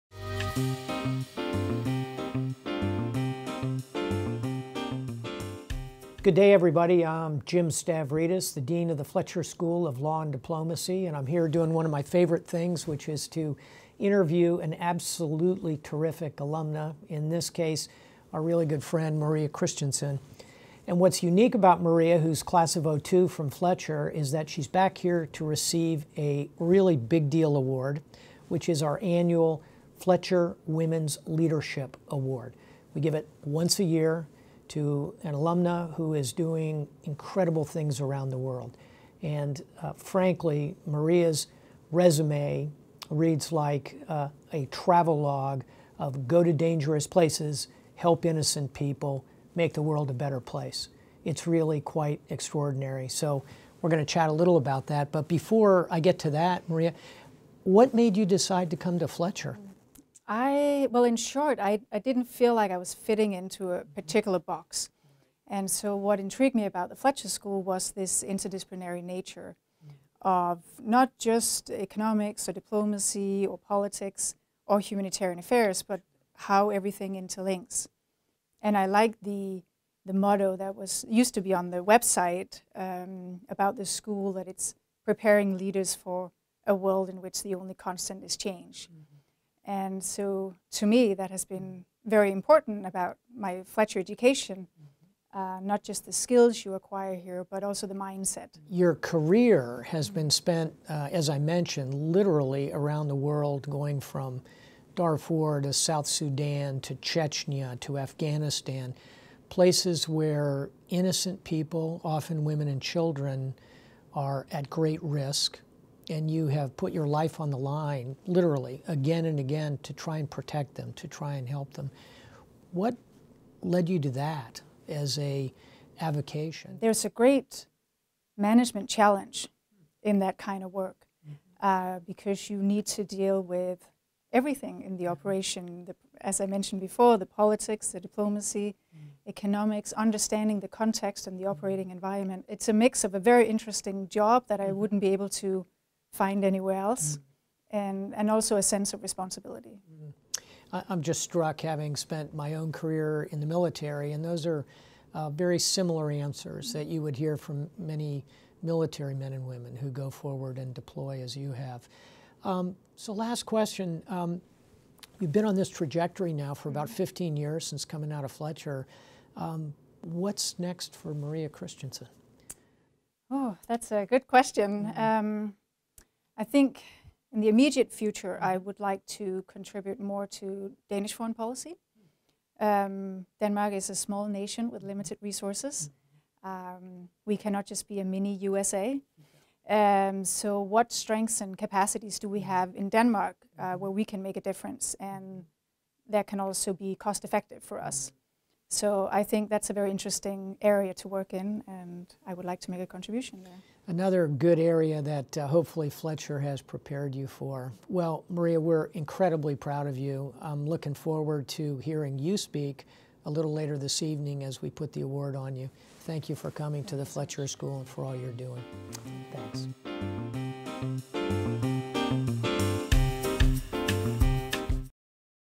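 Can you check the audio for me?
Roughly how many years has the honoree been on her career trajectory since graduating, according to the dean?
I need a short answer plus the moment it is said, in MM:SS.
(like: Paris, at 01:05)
15, at 02:46.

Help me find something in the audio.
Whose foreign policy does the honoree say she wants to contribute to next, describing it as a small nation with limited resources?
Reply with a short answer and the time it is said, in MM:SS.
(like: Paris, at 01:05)
Danish, at 03:00.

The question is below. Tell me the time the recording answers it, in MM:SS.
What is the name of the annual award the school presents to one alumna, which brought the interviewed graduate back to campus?
00:29.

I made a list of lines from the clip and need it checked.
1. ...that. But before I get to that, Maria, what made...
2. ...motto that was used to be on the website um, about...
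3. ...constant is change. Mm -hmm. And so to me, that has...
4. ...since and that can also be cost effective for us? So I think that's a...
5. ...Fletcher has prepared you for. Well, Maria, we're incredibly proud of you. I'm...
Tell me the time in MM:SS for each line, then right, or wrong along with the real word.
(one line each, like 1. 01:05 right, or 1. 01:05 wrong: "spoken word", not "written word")
1. 00:54 right
2. 01:20 right
3. 01:27 right
4. 03:14 wrong: "difference", not "since"
5. 03:25 right.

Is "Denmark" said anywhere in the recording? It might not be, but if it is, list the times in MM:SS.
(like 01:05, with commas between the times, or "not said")
03:03, 03:12.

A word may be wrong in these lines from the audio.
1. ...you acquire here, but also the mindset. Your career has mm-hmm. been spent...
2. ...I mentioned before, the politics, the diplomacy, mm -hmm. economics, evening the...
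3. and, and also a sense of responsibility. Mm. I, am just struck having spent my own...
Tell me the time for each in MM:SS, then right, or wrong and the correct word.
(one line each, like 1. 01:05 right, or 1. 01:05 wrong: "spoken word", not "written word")
1. 01:36 right
2. 02:16 wrong: "understanding", not "evening"
3. 02:27 right.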